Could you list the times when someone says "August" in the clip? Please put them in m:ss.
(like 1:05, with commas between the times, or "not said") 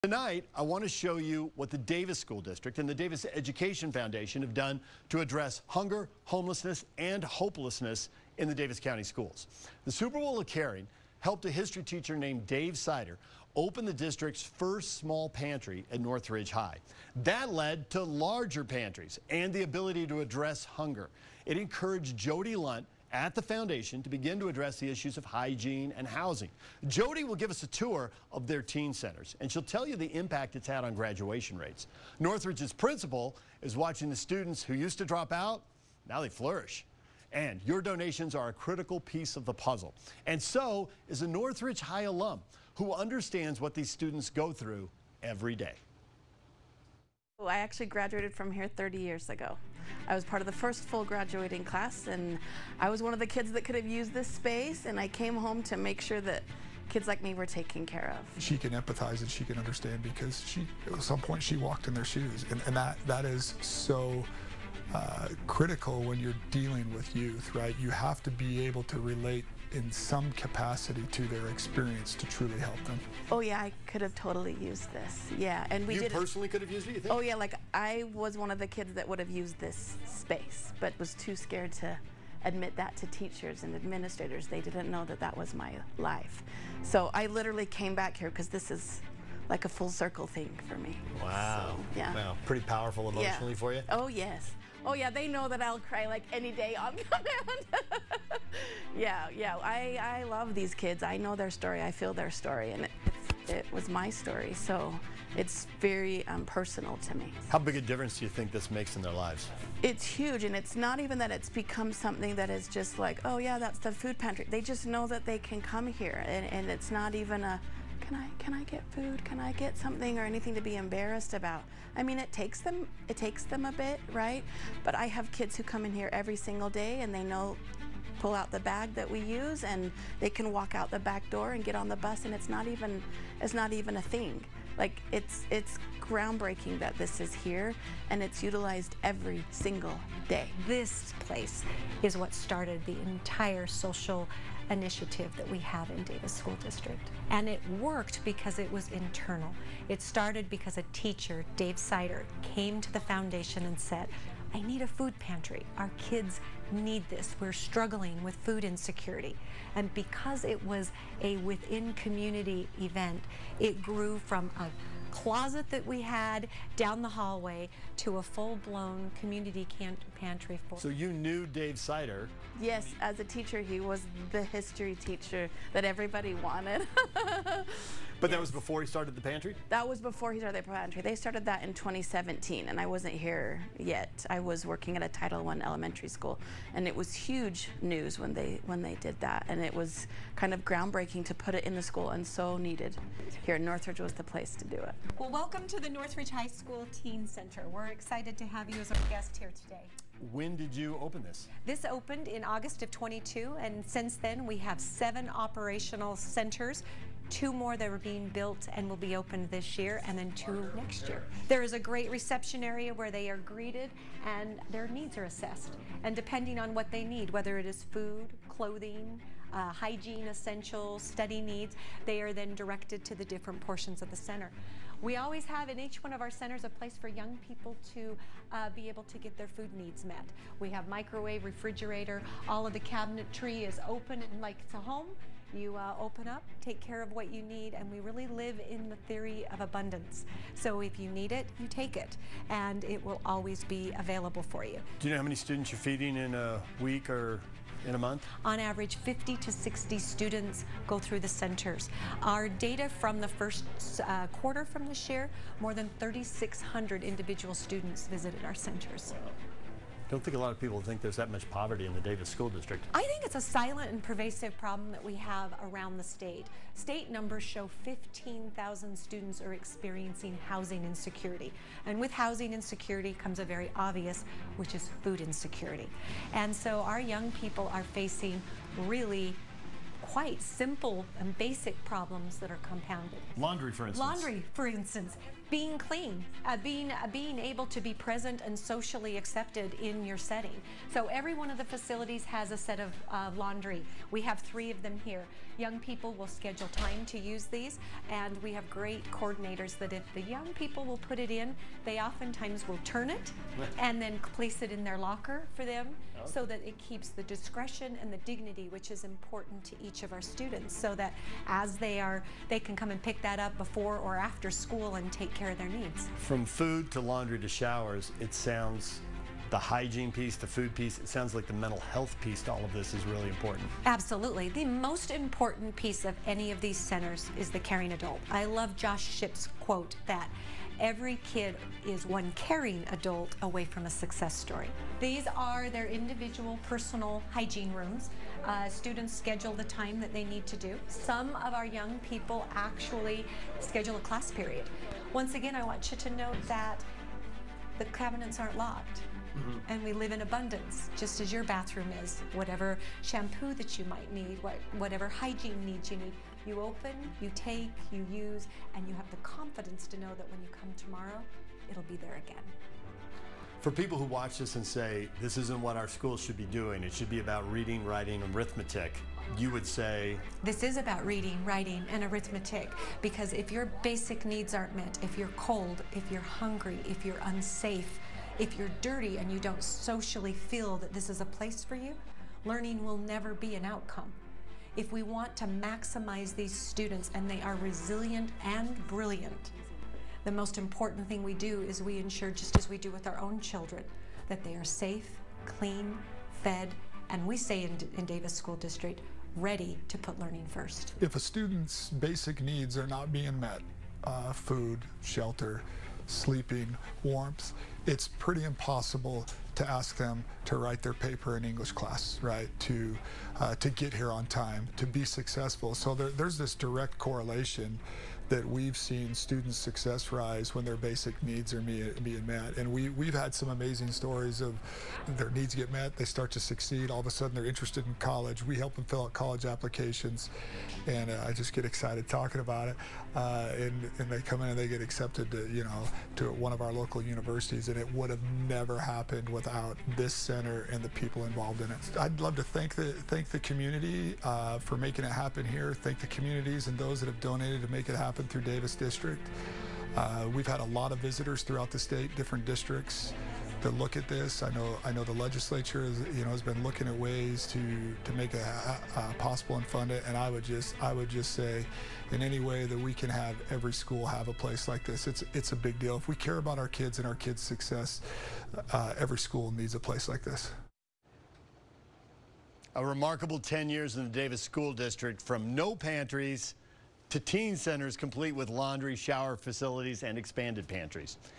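3:22.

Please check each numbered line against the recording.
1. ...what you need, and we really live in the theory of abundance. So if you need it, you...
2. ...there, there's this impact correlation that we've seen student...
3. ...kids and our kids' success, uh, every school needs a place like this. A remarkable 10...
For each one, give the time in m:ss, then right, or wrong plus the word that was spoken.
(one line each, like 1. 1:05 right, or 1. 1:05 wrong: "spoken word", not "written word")
1. 3:57 right
2. 6:55 wrong: "direct", not "impact"
3. 7:46 right.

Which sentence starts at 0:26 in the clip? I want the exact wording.
Jody will give us a tour of their teen centers, and she'll tell you the impact it's had on graduation rates.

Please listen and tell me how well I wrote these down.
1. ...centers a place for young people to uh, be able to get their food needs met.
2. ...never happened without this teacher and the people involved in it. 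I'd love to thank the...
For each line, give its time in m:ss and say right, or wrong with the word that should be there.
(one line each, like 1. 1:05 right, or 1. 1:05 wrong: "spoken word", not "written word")
1. 3:46 right
2. 7:18 wrong: "center", not "teacher".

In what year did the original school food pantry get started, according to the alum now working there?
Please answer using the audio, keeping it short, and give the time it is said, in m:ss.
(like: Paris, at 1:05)
2017, at 3:01.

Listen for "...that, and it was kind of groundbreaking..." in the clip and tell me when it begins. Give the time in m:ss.
3:09.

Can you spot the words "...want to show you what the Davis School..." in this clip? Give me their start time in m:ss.
0:00.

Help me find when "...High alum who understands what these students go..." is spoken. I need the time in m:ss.
0:41.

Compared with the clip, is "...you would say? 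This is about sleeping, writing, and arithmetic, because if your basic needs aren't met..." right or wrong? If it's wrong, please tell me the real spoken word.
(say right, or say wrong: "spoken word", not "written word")
wrong: "reading", not "sleeping".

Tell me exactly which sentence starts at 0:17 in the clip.
That led to larger pantries and the ability to address hunger.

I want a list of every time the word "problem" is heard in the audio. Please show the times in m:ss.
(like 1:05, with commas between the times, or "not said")
4:24, 4:41.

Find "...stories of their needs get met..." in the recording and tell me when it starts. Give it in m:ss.
7:03.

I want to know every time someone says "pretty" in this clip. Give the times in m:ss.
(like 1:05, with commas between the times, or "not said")
1:32, 6:48.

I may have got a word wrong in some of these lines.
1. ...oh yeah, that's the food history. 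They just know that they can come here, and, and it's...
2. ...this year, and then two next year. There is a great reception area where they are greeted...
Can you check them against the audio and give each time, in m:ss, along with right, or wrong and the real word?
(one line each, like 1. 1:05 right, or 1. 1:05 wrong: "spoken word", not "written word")
1. 1:53 wrong: "pantry", not "history"
2. 3:29 right.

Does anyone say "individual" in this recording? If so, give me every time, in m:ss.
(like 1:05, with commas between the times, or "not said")
4:17, 5:35.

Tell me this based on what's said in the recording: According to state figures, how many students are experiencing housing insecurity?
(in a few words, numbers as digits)
15,000.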